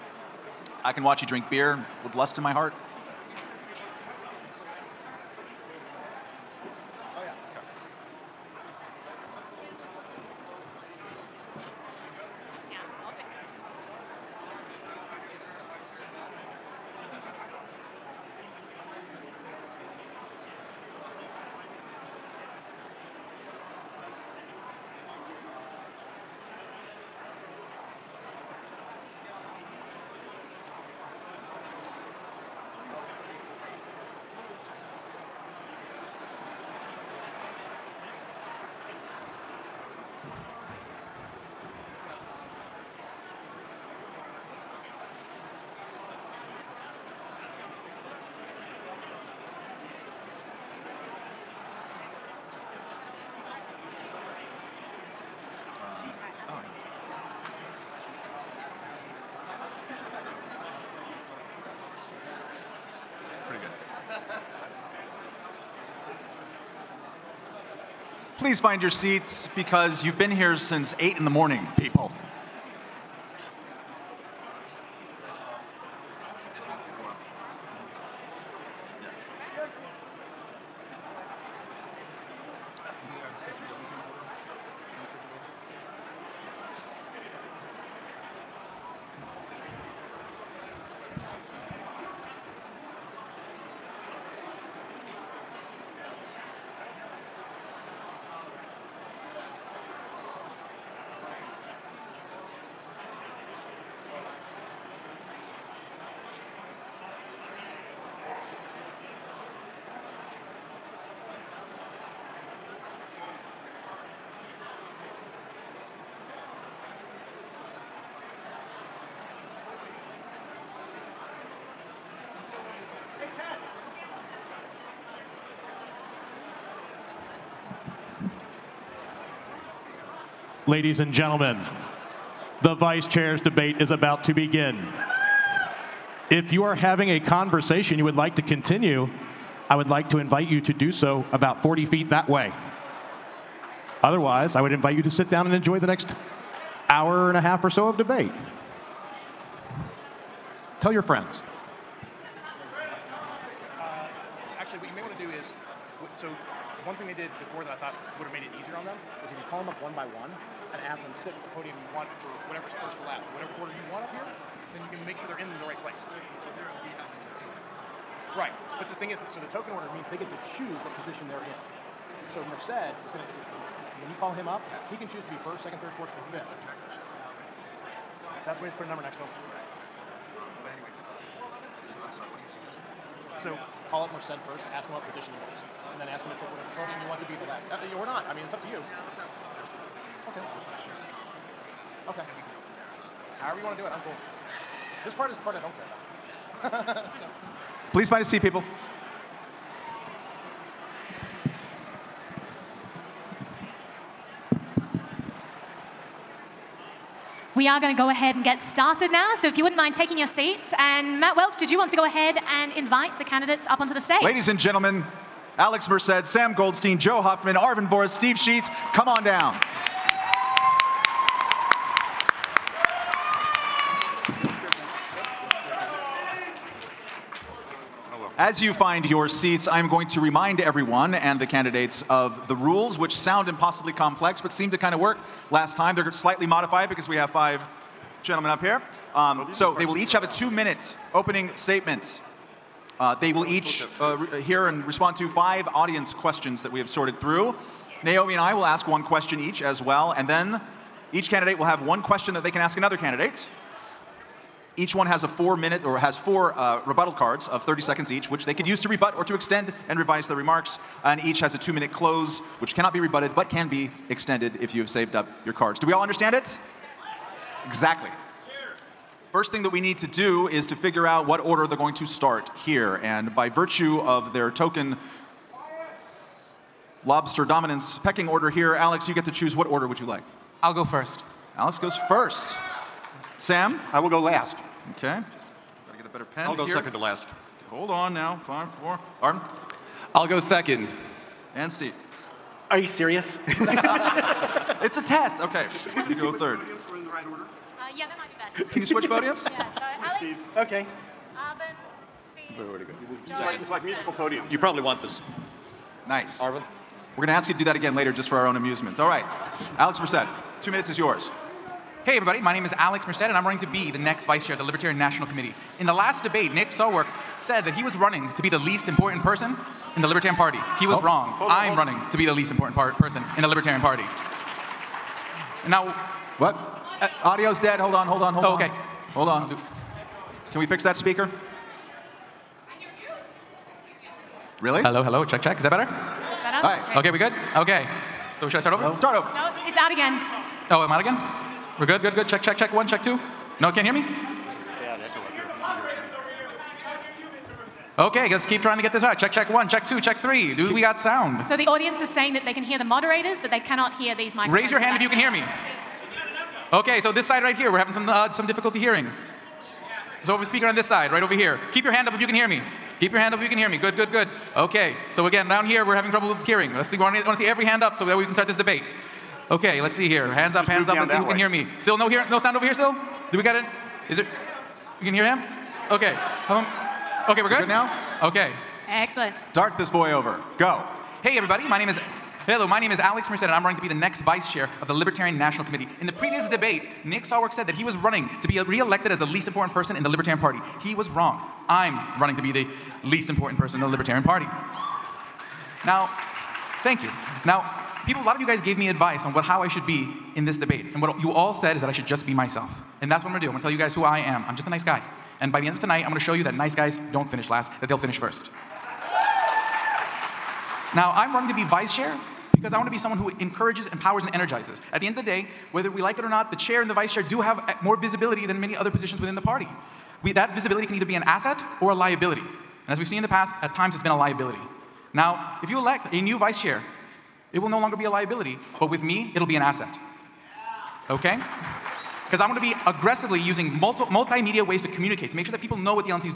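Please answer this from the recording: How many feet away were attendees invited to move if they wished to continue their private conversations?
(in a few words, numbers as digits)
40.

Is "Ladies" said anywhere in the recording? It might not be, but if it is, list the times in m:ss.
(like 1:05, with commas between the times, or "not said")
2:10, 3:34.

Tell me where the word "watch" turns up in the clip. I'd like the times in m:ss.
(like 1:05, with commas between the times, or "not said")
0:01.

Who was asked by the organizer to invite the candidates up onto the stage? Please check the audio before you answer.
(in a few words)
Matt Welch.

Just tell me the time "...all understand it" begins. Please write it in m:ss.
4:25.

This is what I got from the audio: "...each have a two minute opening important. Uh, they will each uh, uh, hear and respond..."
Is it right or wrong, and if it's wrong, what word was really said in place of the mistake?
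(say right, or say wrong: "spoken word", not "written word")
wrong: "statement", not "important".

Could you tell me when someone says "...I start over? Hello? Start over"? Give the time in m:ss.
5:38.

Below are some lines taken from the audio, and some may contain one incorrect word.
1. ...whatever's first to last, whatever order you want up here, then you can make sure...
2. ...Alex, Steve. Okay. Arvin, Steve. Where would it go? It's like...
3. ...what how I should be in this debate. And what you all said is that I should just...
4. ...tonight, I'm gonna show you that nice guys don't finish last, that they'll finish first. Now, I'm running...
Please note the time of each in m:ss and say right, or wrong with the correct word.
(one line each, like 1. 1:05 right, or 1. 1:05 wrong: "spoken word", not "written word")
1. 2:42 right
2. 4:59 right
3. 6:39 right
4. 6:45 right.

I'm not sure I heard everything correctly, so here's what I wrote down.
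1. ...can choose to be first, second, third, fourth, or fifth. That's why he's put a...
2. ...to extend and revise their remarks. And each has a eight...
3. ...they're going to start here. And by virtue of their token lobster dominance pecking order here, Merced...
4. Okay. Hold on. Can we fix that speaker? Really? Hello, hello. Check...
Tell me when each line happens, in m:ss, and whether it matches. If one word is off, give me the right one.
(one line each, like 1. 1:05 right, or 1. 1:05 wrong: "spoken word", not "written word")
1. 2:54 right
2. 4:19 wrong: "two", not "eight"
3. 4:31 wrong: "Alex", not "Merced"
4. 5:28 right.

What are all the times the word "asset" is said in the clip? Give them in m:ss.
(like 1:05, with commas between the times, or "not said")
7:01, 7:09.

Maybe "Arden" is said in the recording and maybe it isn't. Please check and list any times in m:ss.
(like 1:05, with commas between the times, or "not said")
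4:49.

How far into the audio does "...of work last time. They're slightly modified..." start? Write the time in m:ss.
3:54.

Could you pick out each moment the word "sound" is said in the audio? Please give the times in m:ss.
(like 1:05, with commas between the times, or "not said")
3:53, 5:51, 6:12.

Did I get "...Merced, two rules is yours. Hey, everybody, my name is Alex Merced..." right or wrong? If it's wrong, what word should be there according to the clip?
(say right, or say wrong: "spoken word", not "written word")
wrong: "minutes", not "rules".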